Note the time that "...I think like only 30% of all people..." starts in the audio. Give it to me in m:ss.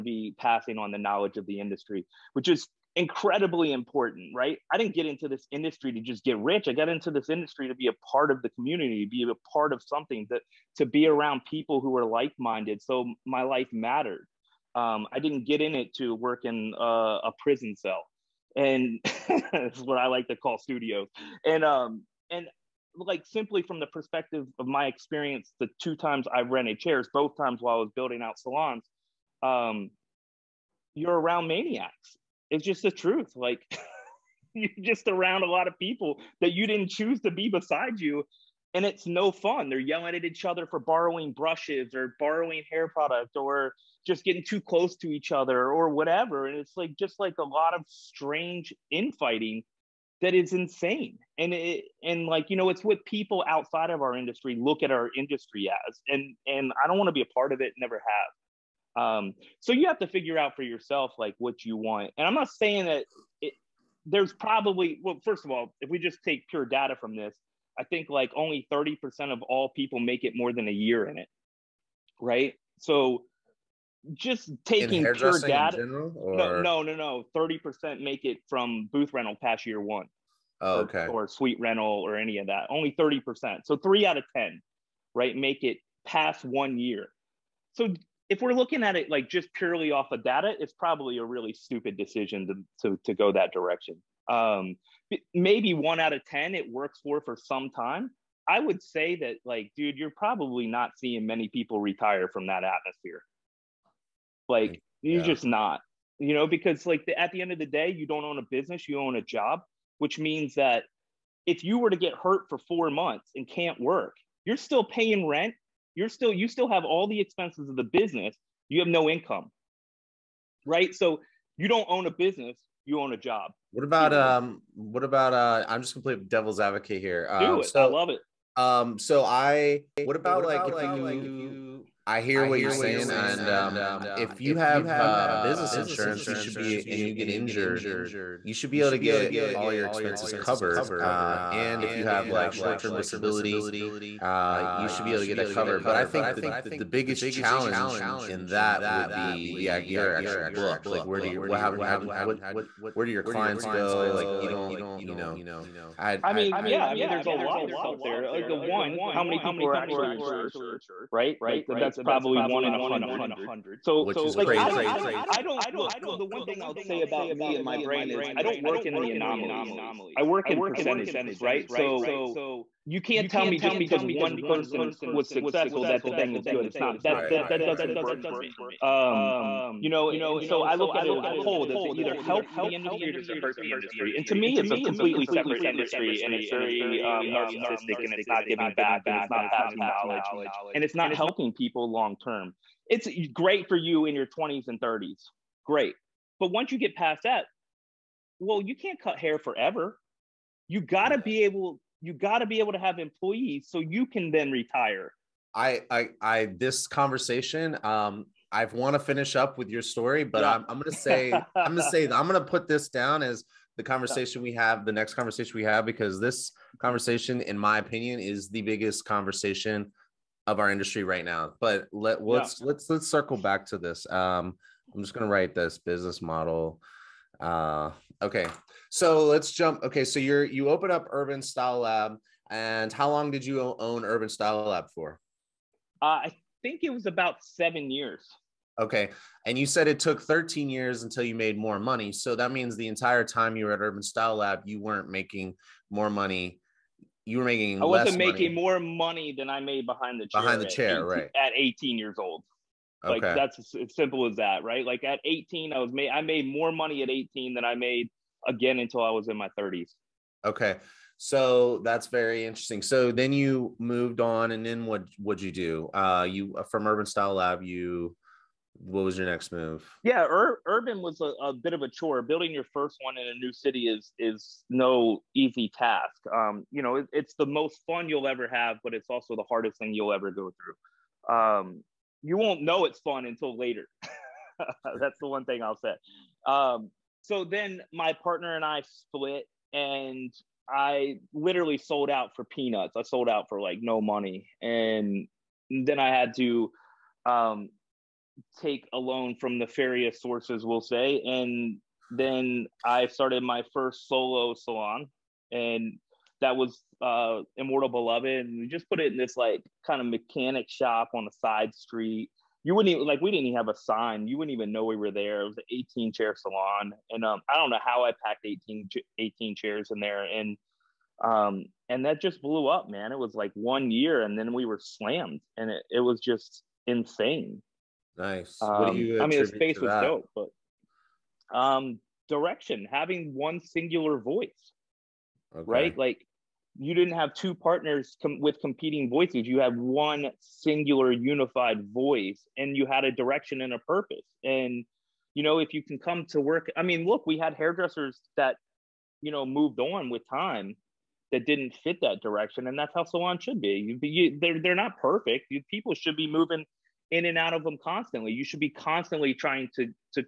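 1:07.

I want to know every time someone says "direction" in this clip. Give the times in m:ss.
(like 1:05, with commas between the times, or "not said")
1:33, 5:32, 5:43, 5:52.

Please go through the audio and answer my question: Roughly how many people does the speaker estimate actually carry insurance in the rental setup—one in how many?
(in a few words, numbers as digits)
one in a hundred.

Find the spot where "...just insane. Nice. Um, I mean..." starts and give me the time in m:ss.
5:26.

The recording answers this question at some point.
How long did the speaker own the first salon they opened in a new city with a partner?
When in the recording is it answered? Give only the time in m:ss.
3:57.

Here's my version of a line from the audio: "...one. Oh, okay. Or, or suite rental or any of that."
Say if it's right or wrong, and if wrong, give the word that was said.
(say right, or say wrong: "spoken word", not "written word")
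right.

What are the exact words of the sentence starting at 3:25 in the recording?
I, I, I, this conversation, um, I want to finish up with your story, but yeah.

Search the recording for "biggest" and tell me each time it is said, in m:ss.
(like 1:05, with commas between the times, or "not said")
2:26, 3:38.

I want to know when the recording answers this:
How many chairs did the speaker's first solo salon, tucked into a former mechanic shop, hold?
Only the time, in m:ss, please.
5:15.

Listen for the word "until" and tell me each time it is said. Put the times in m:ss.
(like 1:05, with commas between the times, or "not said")
4:01, 4:18, 4:43.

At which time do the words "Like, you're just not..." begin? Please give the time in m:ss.
1:44.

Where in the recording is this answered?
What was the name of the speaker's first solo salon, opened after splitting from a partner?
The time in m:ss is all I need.
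5:07.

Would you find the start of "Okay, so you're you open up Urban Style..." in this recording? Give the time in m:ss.
3:49.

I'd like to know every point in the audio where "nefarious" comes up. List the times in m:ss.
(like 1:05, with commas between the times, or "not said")
4:59.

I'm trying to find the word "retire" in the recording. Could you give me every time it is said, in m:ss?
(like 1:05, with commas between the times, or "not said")
1:41, 3:24.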